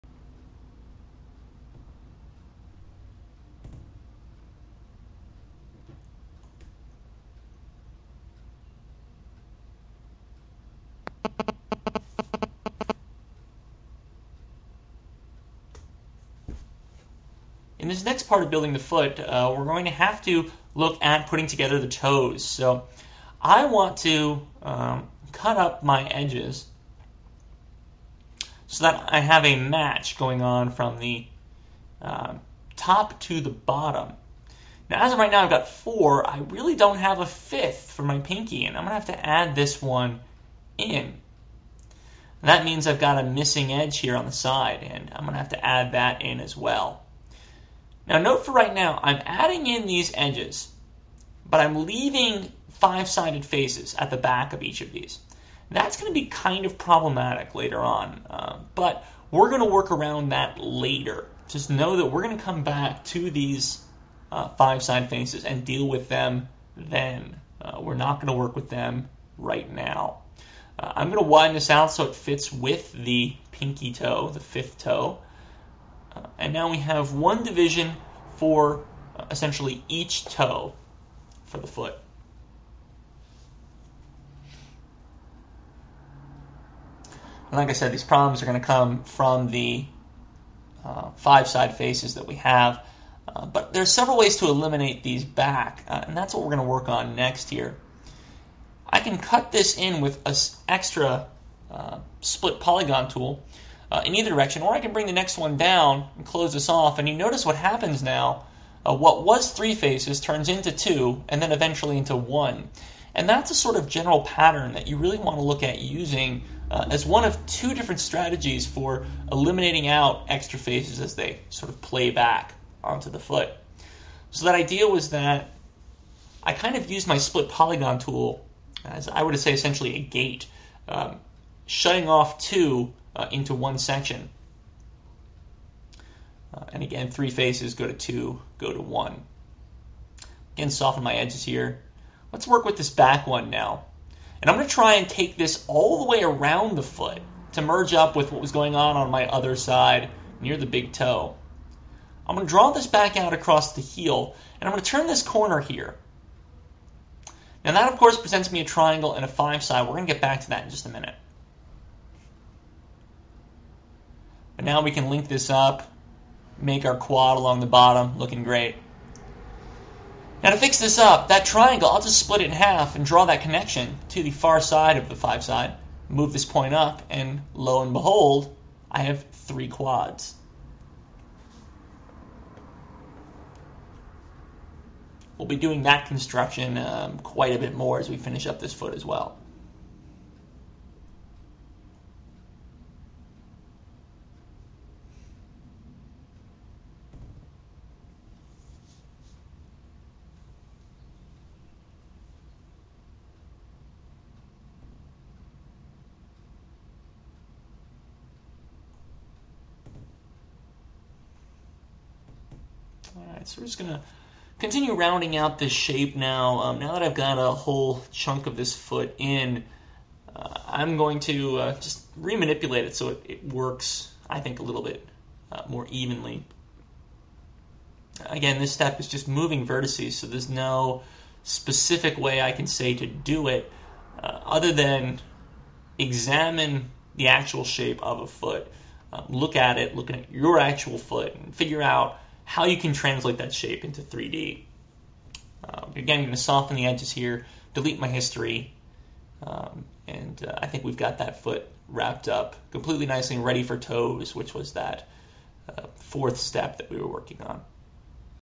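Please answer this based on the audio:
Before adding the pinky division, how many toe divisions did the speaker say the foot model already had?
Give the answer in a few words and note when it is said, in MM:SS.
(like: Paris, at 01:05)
4, at 00:35.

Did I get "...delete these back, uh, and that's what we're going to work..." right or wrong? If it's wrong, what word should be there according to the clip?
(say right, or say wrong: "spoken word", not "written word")
wrong: "eliminate", not "delete".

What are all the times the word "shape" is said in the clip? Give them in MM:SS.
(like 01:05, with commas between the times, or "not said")
03:35, 03:57, 04:03.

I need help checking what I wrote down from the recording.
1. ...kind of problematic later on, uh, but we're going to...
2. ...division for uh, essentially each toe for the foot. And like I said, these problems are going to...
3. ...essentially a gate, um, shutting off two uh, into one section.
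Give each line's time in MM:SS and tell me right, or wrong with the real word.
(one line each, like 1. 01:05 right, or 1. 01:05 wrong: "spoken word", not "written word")
1. 00:56 right
2. 01:17 right
3. 02:09 right.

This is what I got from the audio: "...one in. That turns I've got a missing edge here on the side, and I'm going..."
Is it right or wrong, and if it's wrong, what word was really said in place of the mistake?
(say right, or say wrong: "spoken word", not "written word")
wrong: "means", not "turns".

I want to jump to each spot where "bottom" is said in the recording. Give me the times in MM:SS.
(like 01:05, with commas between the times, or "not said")
00:33, 02:47.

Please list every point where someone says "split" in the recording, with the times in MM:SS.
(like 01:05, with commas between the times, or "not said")
01:42, 02:07, 02:52.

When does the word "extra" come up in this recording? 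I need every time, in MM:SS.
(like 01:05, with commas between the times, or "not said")
01:40, 02:00.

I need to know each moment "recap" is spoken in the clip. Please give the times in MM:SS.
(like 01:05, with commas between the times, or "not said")
not said.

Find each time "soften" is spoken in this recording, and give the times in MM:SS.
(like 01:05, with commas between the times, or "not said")
02:20, 04:06.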